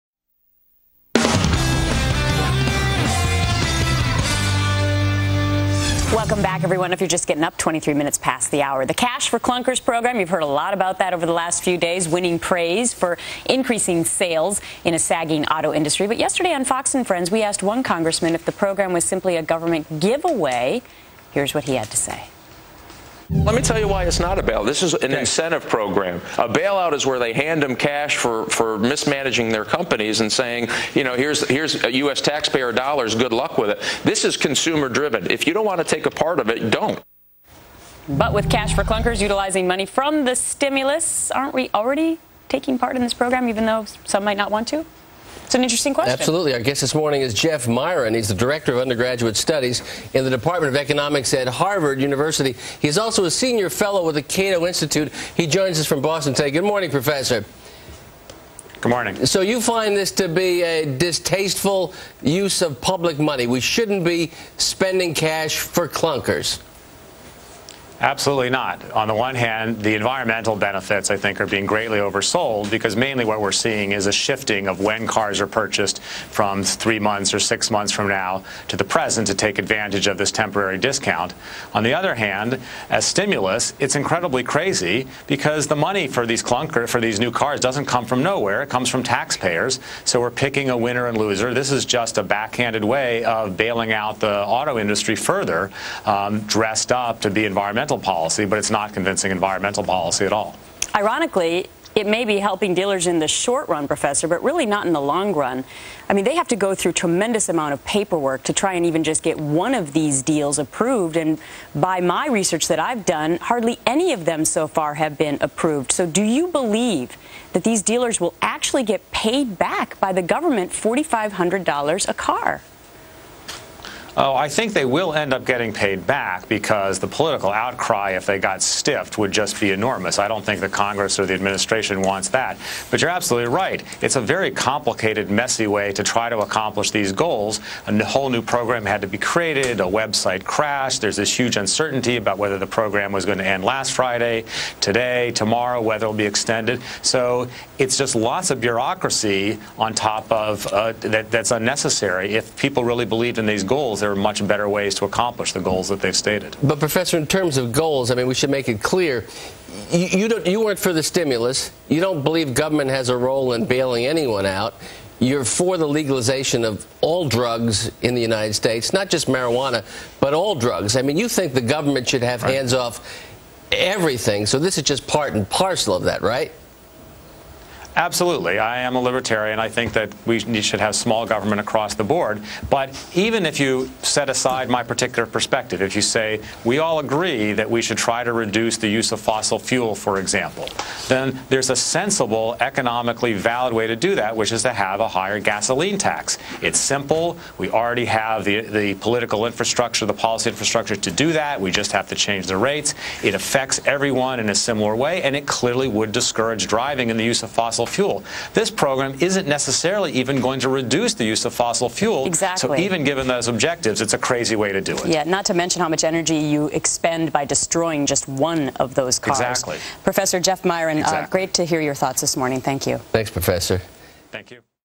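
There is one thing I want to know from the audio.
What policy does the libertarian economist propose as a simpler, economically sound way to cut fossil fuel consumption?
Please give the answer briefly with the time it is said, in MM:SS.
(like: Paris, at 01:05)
A higher gasoline tax, at 03:15.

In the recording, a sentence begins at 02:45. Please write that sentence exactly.
You're for the legalization of all drugs in the United States, not just marijuana, but all drugs.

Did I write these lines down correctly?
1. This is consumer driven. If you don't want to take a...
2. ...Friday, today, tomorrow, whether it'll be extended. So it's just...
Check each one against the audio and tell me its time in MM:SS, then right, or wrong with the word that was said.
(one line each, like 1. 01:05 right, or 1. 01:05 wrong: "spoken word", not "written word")
1. 00:34 right
2. 02:23 right.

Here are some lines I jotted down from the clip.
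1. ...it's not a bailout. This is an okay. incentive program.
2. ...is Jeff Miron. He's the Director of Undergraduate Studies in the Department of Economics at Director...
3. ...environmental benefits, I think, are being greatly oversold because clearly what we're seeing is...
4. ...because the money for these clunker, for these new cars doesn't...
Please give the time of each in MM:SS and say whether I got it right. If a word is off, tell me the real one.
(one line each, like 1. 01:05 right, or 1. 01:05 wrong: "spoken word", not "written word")
1. 00:24 right
2. 00:47 wrong: "Harvard", not "Director"
3. 01:09 wrong: "mainly", not "clearly"
4. 01:25 right.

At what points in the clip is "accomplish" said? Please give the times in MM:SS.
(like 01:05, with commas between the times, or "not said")
02:16, 02:35.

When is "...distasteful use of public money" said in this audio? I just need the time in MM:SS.
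01:00.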